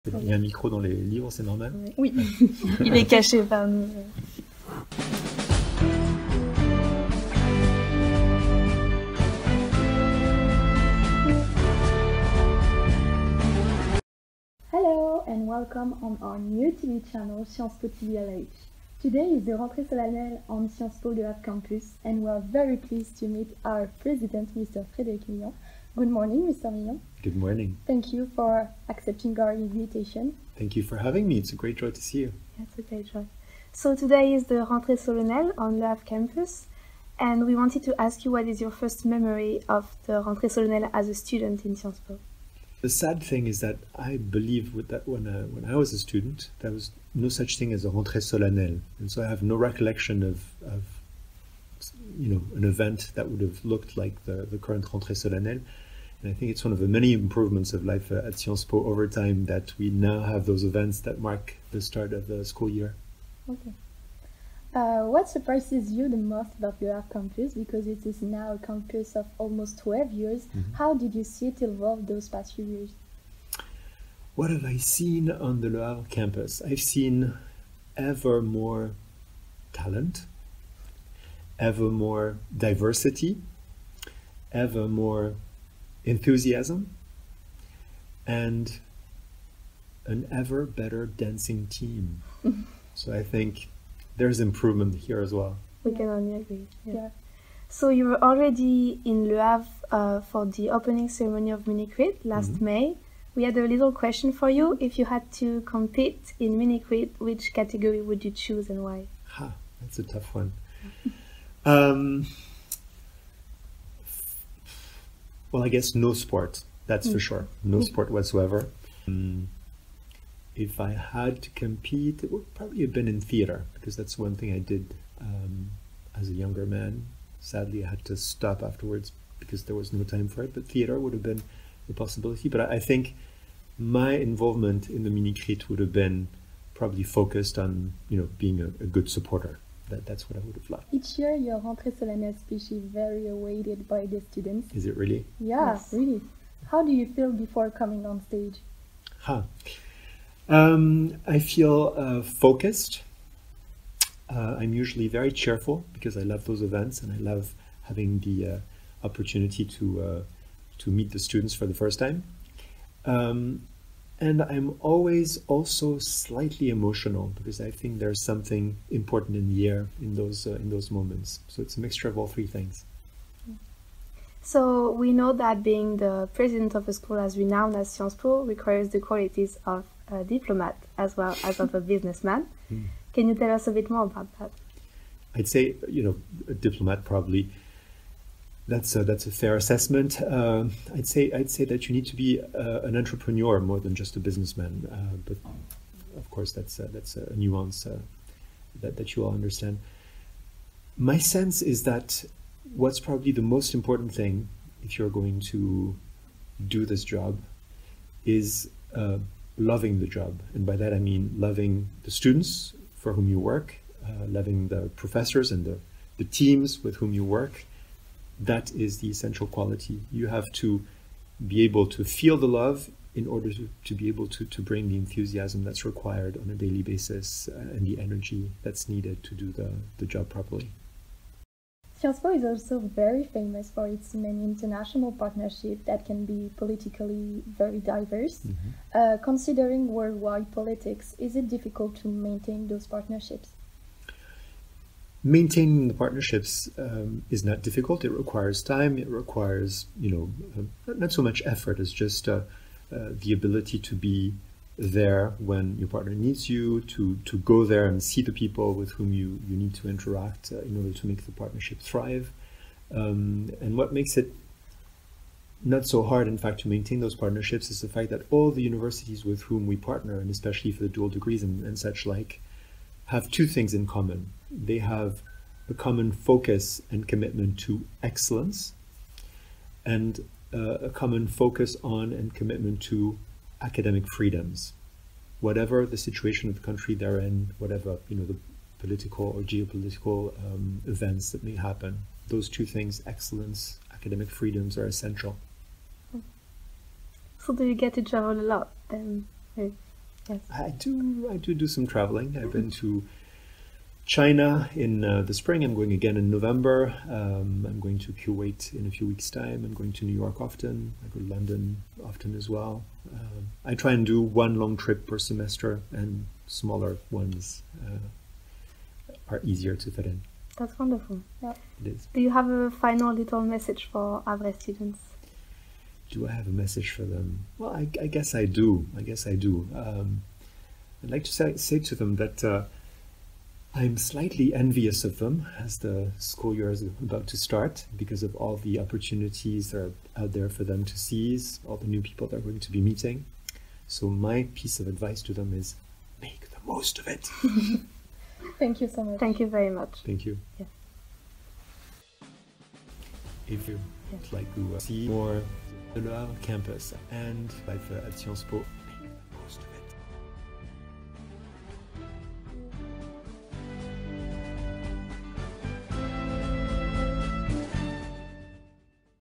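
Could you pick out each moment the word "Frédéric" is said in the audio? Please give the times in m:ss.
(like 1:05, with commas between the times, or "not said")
0:24.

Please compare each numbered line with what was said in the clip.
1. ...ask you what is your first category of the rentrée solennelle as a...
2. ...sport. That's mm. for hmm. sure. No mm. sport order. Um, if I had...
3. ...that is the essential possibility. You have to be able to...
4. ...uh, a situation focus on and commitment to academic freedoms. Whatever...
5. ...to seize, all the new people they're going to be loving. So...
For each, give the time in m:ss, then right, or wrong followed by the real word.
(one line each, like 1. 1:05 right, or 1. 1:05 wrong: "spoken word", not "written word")
1. 0:38 wrong: "memory", not "category"
2. 1:56 wrong: "whatsoever", not "order"
3. 3:38 wrong: "quality", not "possibility"
4. 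4:40 wrong: "common", not "situation"
5. 5:40 wrong: "meeting", not "loving".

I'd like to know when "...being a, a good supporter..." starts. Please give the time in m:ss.
2:18.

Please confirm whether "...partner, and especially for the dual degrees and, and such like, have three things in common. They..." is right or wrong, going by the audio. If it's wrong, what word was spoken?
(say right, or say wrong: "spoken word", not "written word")
wrong: "two", not "three".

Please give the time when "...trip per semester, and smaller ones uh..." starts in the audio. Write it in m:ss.
5:14.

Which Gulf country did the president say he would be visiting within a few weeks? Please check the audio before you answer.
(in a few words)
Kuwait.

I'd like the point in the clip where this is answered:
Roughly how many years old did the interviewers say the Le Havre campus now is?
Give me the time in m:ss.
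1:09.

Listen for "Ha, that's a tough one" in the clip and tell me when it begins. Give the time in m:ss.
1:49.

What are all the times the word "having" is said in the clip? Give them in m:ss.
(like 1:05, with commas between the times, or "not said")
0:30, 2:37.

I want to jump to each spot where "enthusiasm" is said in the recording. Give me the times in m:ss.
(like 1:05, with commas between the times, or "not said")
1:26, 3:44.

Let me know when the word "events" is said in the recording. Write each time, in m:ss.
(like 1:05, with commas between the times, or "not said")
0:52, 1:00, 2:36, 4:50.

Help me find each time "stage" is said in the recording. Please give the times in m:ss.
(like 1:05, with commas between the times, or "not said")
2:28.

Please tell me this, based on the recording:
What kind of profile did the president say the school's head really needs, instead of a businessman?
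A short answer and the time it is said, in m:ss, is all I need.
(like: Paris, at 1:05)
An entrepreneur, at 3:12.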